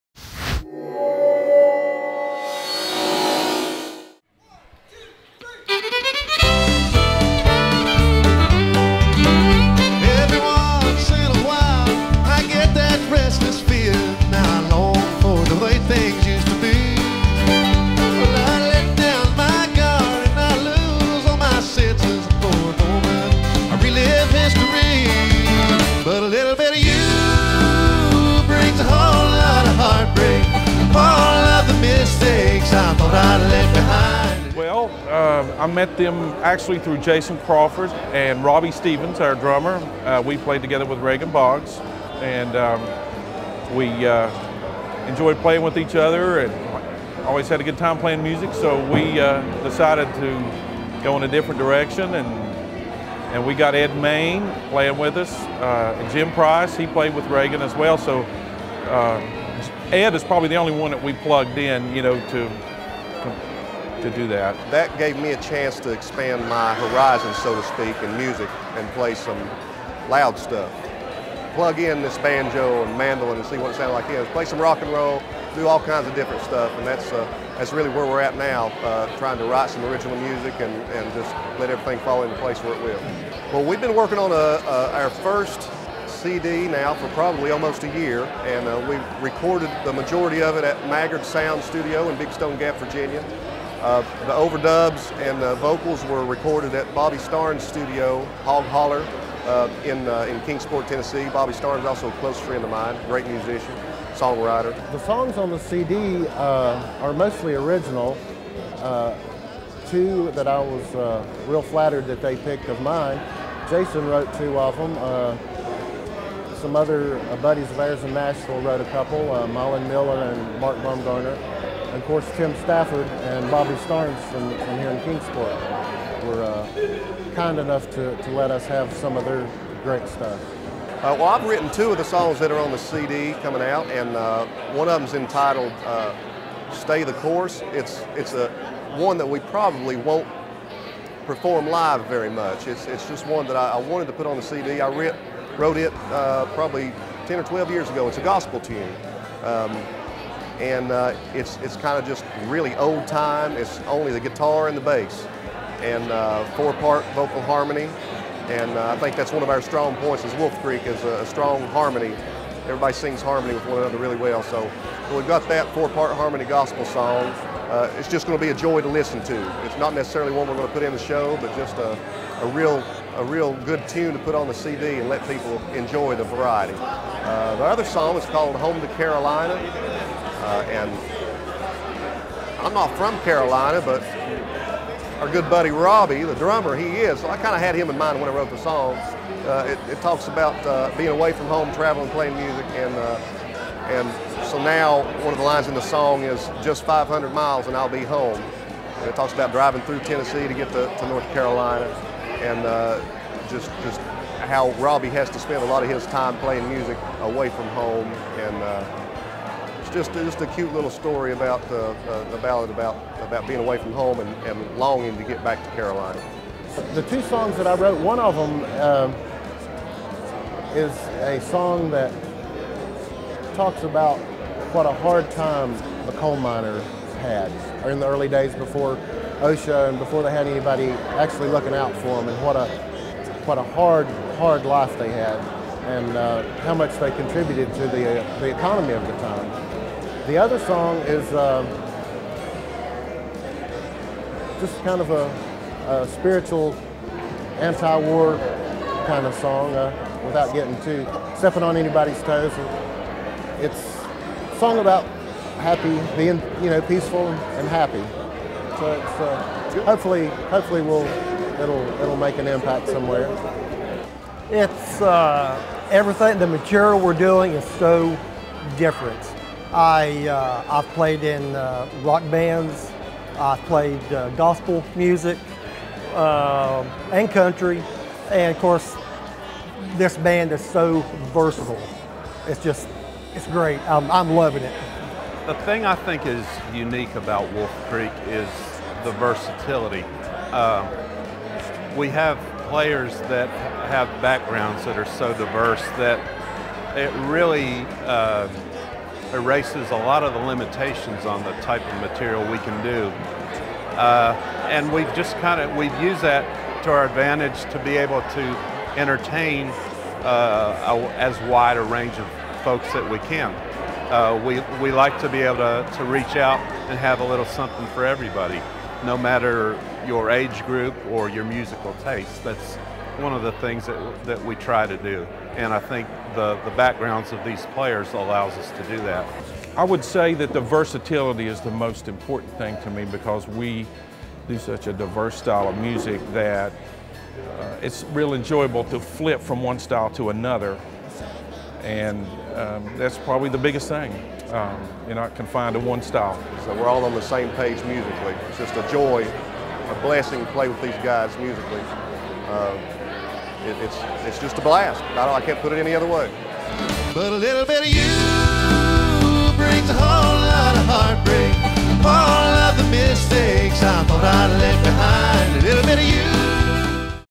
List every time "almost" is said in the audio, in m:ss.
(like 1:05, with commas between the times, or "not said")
1:27.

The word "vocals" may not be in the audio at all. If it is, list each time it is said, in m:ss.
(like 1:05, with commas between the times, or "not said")
1:35, 2:37.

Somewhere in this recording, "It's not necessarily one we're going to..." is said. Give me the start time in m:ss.
2:49.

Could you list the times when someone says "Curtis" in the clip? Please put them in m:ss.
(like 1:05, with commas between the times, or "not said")
not said.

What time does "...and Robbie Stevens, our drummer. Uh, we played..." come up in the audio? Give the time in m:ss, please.
0:38.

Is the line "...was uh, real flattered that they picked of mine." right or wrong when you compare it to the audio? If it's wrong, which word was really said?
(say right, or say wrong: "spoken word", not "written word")
right.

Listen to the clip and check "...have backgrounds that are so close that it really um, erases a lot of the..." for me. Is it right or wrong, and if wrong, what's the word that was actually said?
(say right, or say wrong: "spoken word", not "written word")
wrong: "diverse", not "close".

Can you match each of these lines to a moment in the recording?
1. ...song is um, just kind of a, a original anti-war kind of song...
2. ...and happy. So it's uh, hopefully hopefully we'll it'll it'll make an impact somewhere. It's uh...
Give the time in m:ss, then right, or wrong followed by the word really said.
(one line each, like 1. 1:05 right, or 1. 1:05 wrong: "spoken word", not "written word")
1. 4:00 wrong: "spiritual", not "original"
2. 4:17 right.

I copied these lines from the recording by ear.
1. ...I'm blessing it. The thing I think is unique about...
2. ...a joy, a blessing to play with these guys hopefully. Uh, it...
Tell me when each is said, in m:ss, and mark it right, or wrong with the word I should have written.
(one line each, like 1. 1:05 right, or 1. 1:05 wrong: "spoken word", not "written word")
1. 4:44 wrong: "loving", not "blessing"
2. 5:48 wrong: "musically", not "hopefully".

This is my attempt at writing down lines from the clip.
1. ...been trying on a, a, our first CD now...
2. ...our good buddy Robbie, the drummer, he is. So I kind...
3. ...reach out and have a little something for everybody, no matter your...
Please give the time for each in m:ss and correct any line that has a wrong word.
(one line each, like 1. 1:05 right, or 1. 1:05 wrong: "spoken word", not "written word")
1. 1:23 wrong: "working", not "trying"
2. 3:05 right
3. 5:16 right.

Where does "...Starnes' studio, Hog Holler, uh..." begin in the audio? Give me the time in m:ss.
1:37.